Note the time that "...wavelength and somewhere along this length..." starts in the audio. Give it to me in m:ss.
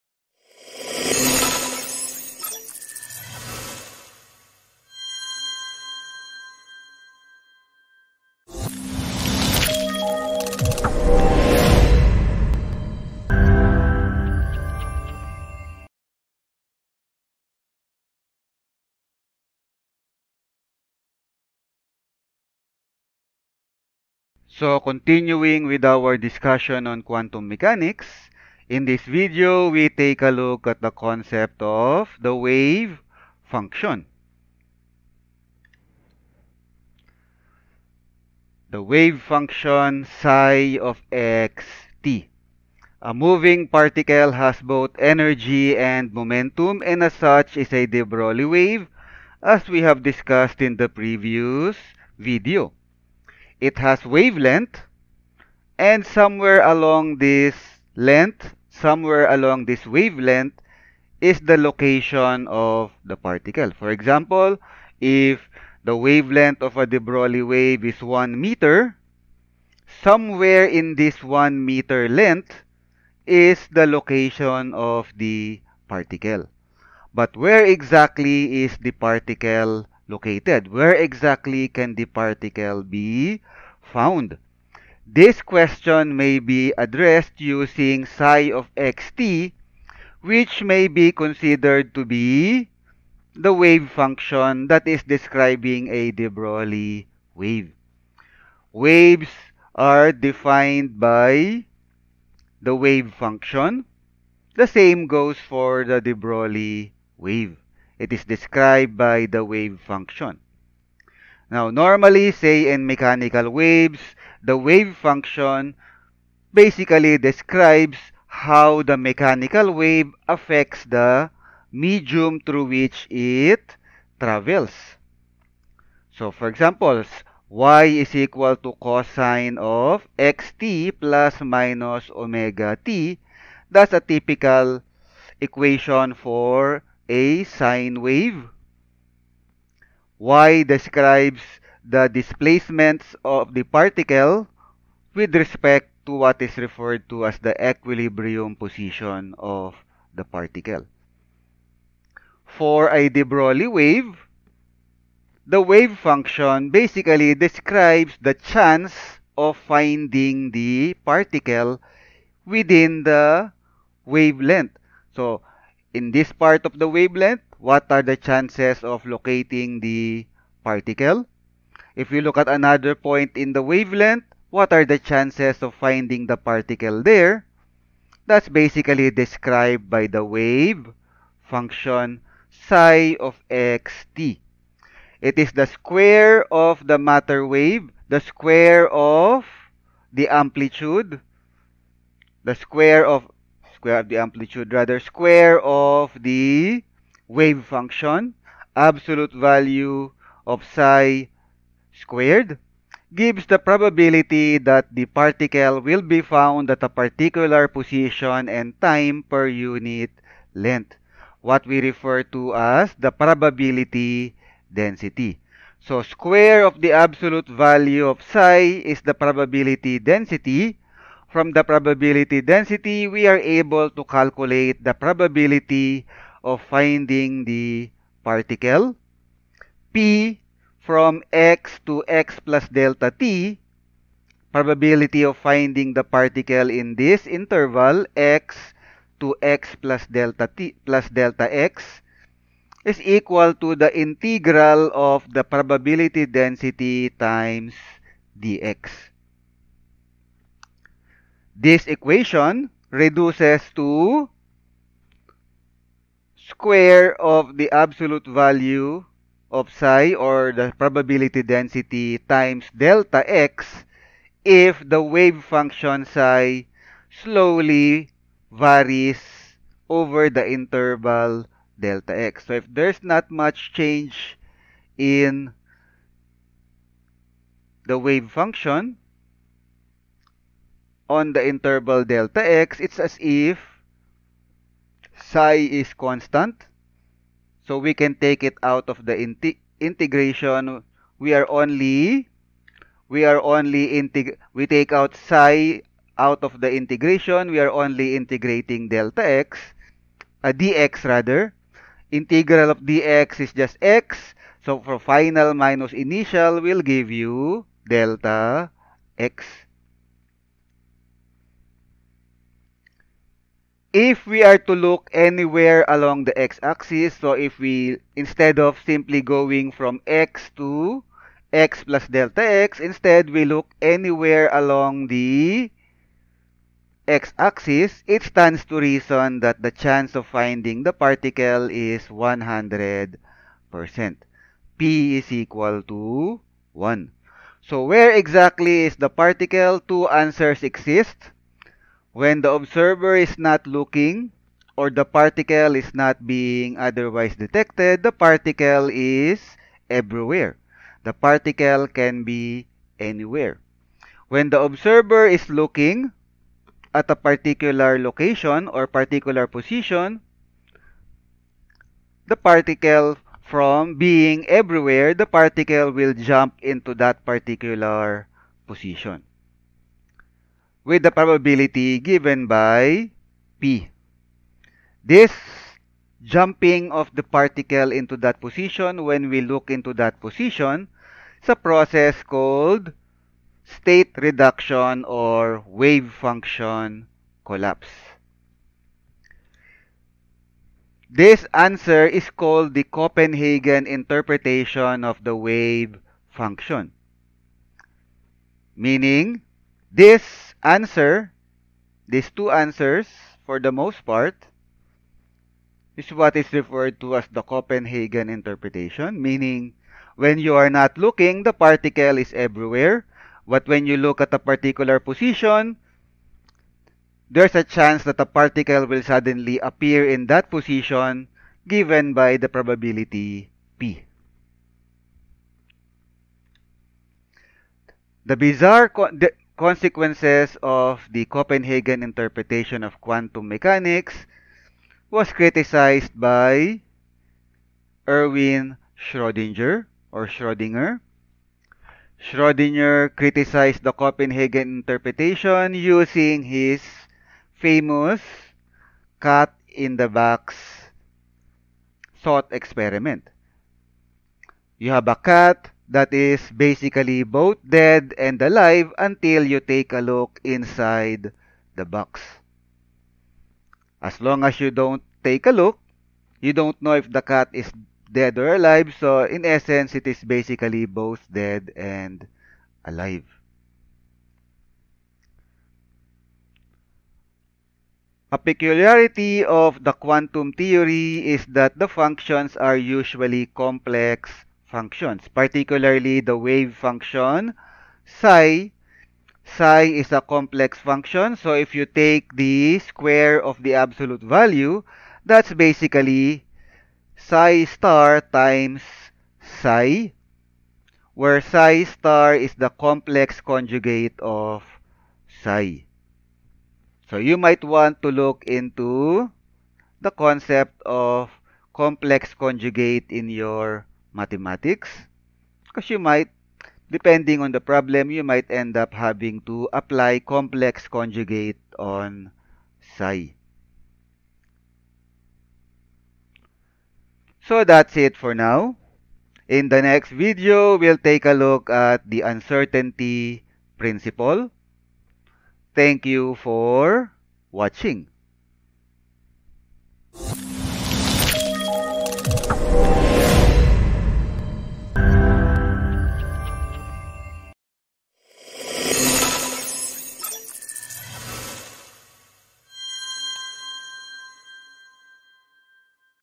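0:54.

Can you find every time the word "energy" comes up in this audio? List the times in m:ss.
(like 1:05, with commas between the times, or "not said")
0:44.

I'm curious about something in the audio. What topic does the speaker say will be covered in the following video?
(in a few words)
uncertainty principle.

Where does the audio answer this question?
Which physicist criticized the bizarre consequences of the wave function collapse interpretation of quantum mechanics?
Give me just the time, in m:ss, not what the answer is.
7:18.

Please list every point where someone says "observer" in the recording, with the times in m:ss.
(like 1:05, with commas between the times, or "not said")
5:42, 5:54.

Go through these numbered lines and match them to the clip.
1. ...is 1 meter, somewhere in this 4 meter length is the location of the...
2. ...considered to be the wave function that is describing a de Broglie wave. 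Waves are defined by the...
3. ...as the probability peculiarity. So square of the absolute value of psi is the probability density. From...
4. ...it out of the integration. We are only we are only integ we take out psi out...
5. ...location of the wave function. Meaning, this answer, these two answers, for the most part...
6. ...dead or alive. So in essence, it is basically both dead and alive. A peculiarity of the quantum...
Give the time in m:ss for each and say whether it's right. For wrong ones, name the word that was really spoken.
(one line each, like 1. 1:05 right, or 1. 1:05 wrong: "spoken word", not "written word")
1. 1:07 wrong: "1", not "4"
2. 1:31 right
3. 3:32 wrong: "density", not "peculiarity"
4. 4:48 right
5. 6:33 wrong: "interpretation", not "location"
6. 7:48 right.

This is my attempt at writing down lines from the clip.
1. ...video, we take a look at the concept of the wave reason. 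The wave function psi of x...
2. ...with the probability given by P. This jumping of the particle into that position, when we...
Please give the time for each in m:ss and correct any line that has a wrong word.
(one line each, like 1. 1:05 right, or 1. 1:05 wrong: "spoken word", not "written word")
1. 0:29 wrong: "function", not "reason"
2. 6:10 right.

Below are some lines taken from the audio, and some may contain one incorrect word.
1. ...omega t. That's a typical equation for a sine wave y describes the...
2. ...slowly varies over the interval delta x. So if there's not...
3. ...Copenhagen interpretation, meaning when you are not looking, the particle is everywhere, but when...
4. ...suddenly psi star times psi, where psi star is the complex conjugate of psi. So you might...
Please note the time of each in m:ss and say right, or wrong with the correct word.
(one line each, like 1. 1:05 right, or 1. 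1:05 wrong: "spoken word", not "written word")
1. 2:12 right
2. 4:27 right
3. 6:47 right
4. 8:15 wrong: "basically", not "suddenly".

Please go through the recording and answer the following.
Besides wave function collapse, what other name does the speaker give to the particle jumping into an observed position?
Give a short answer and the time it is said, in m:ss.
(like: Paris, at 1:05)
state reduction, at 6:23.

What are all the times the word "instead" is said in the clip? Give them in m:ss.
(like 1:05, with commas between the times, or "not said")
5:18, 5:22.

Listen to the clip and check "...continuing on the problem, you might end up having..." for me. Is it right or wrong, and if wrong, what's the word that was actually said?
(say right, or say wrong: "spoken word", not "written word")
wrong: "depending", not "continuing".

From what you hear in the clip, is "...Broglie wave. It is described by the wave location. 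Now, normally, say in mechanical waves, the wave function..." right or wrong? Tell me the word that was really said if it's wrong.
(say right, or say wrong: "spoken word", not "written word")
wrong: "function", not "location".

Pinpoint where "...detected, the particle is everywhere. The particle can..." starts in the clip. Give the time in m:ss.
5:47.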